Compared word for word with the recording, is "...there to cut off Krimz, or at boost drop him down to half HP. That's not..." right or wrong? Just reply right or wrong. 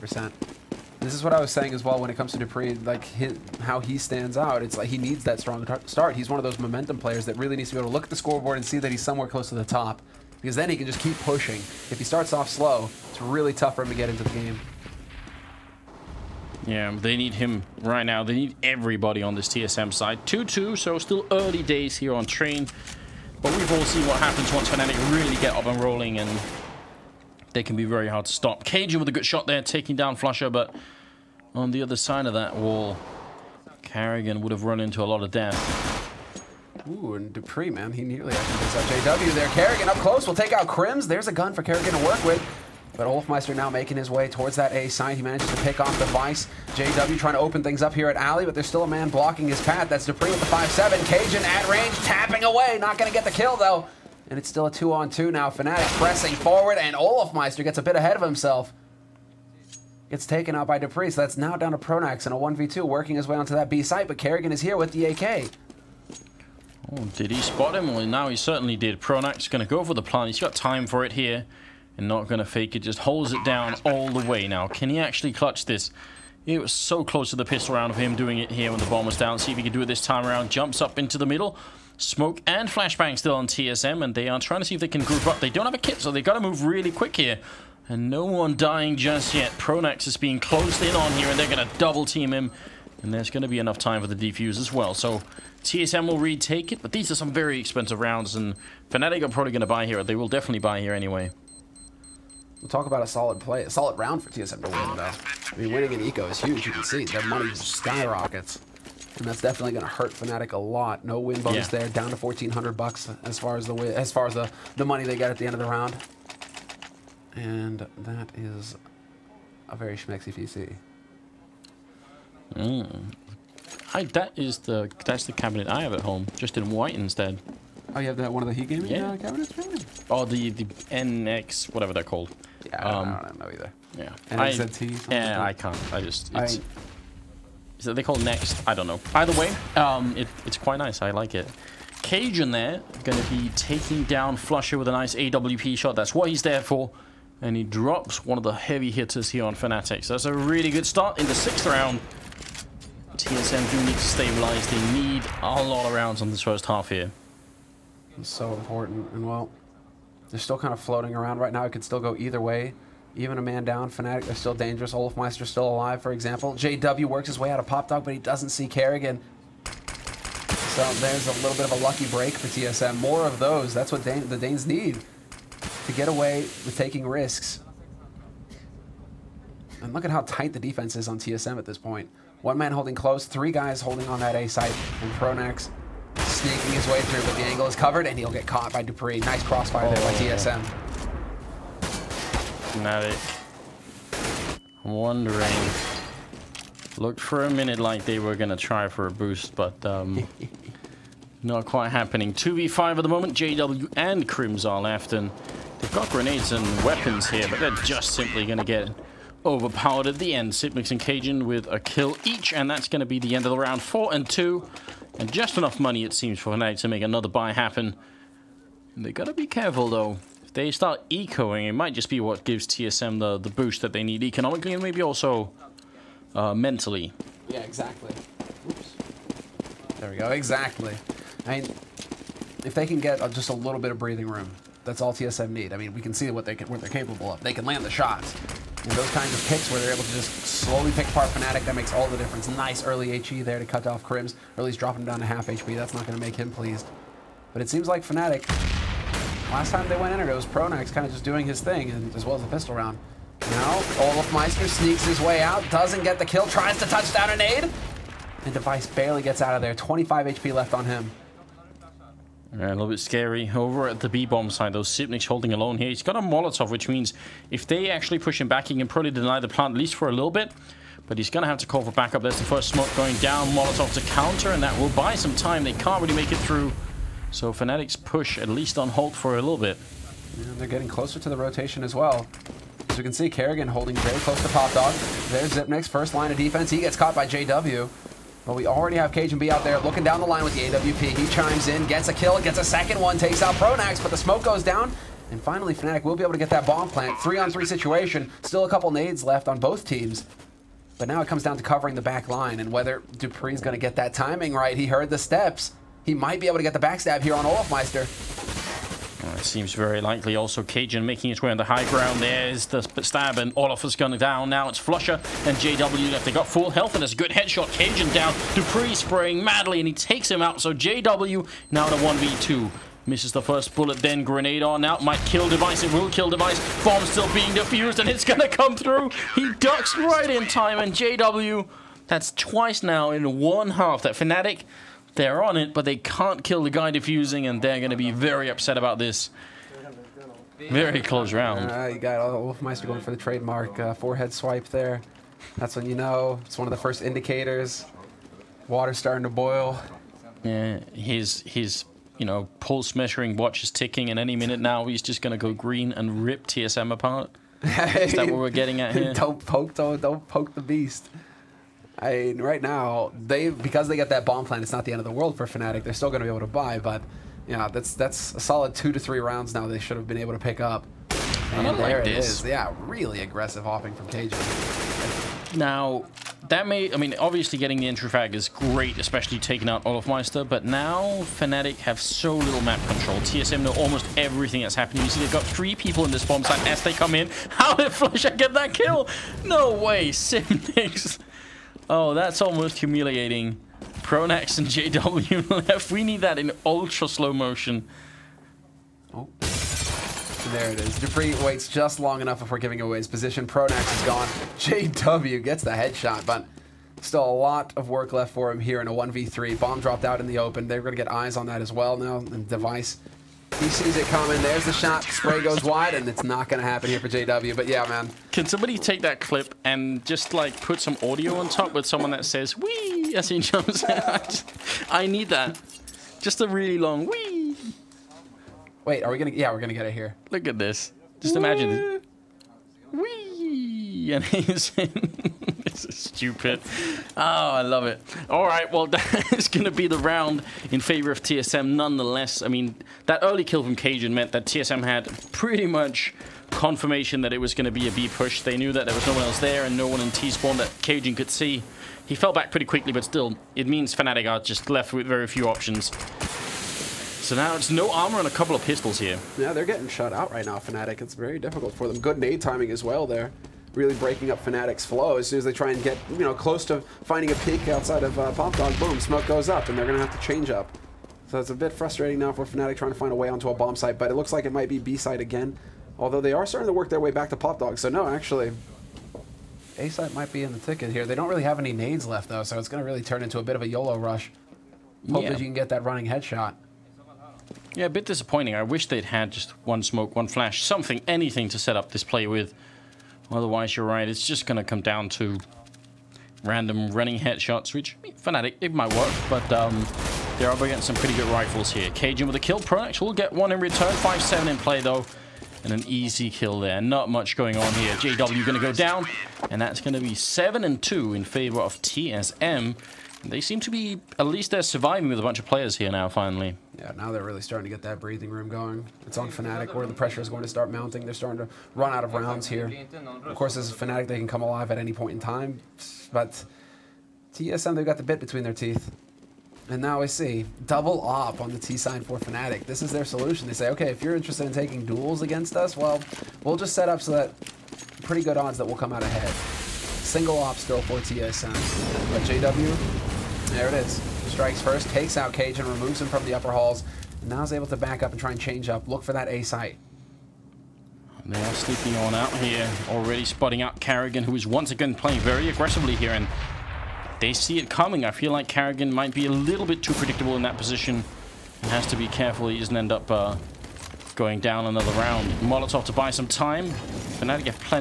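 wrong.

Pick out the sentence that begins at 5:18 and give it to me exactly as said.
Dupree spraying madly, and he takes him out.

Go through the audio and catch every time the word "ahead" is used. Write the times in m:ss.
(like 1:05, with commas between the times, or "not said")
0:57, 8:59.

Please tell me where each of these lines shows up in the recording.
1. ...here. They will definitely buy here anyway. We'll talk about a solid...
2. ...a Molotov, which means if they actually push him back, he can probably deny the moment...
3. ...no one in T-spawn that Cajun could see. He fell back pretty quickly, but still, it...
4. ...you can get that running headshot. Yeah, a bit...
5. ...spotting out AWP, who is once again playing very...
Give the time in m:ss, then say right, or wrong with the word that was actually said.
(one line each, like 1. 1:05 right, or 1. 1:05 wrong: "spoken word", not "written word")
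1. 1:39 right
2. 4:26 wrong: "plant", not "moment"
3. 7:29 right
4. 8:05 right
5. 9:13 wrong: "Karrigan", not "AWP".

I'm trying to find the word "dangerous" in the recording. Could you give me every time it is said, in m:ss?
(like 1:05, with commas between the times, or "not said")
2:44.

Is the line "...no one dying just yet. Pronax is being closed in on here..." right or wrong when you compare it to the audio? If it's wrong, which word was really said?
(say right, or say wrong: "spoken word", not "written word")
right.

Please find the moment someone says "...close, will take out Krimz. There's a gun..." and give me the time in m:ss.
0:39.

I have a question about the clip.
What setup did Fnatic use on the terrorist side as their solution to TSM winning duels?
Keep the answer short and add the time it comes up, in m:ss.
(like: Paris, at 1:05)
Double op, at 8:50.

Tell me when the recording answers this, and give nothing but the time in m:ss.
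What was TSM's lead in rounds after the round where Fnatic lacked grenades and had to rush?
8:30.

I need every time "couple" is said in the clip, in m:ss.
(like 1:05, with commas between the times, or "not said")
4:58, 7:38.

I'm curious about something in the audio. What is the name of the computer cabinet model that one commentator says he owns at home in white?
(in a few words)
NXT.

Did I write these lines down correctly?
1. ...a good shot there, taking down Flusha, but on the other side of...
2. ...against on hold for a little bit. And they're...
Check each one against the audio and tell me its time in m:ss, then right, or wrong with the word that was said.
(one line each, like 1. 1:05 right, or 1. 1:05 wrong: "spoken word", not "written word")
1. 0:29 right
2. 4:38 wrong: "least", not "against".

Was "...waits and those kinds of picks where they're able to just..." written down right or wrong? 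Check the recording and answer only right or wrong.
wrong.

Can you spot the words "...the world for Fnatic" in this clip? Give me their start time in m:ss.
6:05.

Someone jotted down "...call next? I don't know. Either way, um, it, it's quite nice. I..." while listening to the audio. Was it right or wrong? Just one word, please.
right.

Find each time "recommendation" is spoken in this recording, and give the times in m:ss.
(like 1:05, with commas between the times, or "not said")
not said.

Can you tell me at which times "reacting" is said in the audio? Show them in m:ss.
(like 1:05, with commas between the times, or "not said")
not said.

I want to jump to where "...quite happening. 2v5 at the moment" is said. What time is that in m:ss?
3:21.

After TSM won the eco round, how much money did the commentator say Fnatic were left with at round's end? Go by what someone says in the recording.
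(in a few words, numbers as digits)
1,400.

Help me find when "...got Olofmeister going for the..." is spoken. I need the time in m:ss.
5:41.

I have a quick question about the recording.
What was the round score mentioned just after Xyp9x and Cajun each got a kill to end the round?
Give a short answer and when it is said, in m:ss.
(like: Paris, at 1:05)
4-2, at 3:33.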